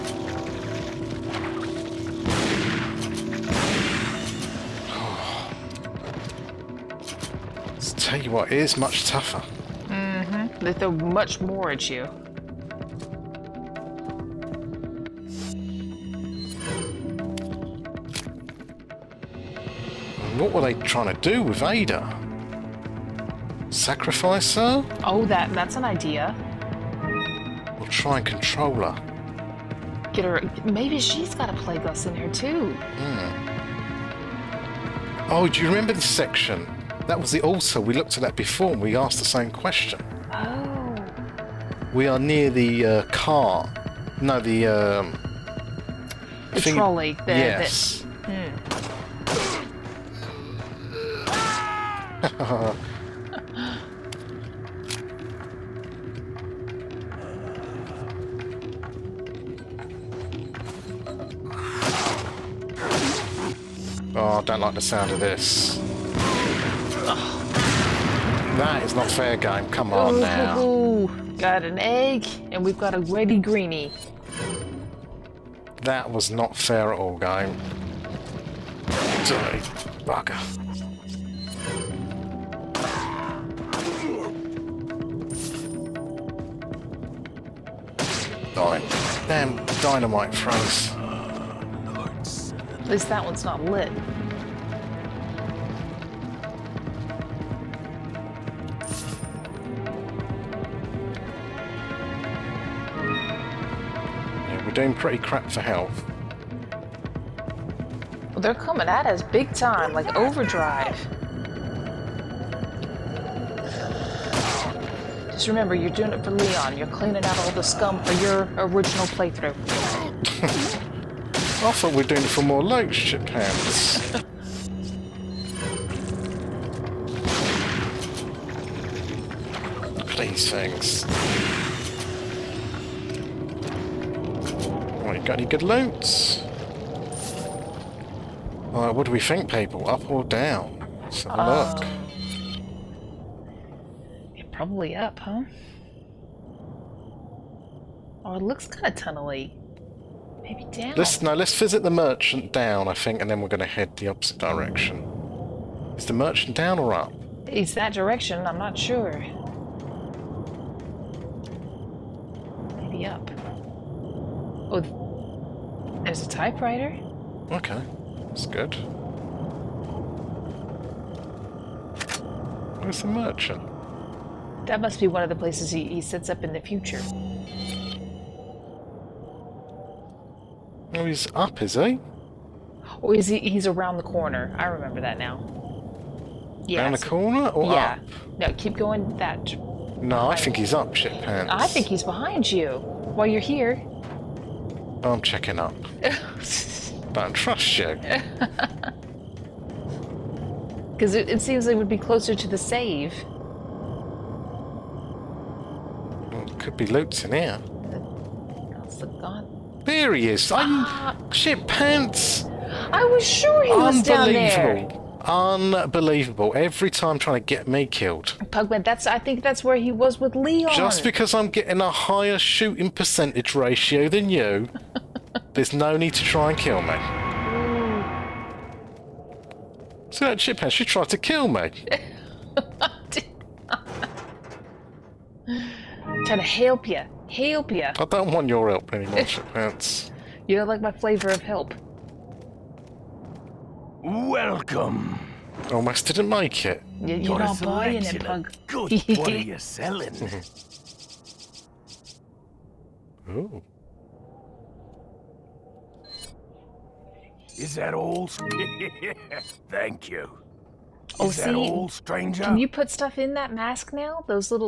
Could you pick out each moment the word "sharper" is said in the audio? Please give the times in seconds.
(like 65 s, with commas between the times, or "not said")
not said.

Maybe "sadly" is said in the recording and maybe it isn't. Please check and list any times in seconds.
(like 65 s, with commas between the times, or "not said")
not said.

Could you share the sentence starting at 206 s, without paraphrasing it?
Well, could be loot in here.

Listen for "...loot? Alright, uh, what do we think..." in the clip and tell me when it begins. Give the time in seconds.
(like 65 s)
135 s.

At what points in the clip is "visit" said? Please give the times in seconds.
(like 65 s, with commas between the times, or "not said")
151 s.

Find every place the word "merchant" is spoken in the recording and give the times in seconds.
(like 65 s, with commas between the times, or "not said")
151 s, 156 s, 173 s.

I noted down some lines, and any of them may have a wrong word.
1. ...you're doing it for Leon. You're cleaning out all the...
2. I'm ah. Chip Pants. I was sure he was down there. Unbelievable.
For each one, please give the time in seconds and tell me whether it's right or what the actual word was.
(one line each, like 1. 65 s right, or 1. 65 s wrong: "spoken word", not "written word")
1. 115 s right
2. 210 s right.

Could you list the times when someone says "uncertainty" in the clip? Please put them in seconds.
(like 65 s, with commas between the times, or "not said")
not said.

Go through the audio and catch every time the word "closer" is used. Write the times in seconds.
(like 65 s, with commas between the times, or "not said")
201 s.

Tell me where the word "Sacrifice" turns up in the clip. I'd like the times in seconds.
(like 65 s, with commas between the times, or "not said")
23 s.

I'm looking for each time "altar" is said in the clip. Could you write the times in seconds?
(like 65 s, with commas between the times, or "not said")
37 s.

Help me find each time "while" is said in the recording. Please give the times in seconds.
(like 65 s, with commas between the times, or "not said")
193 s.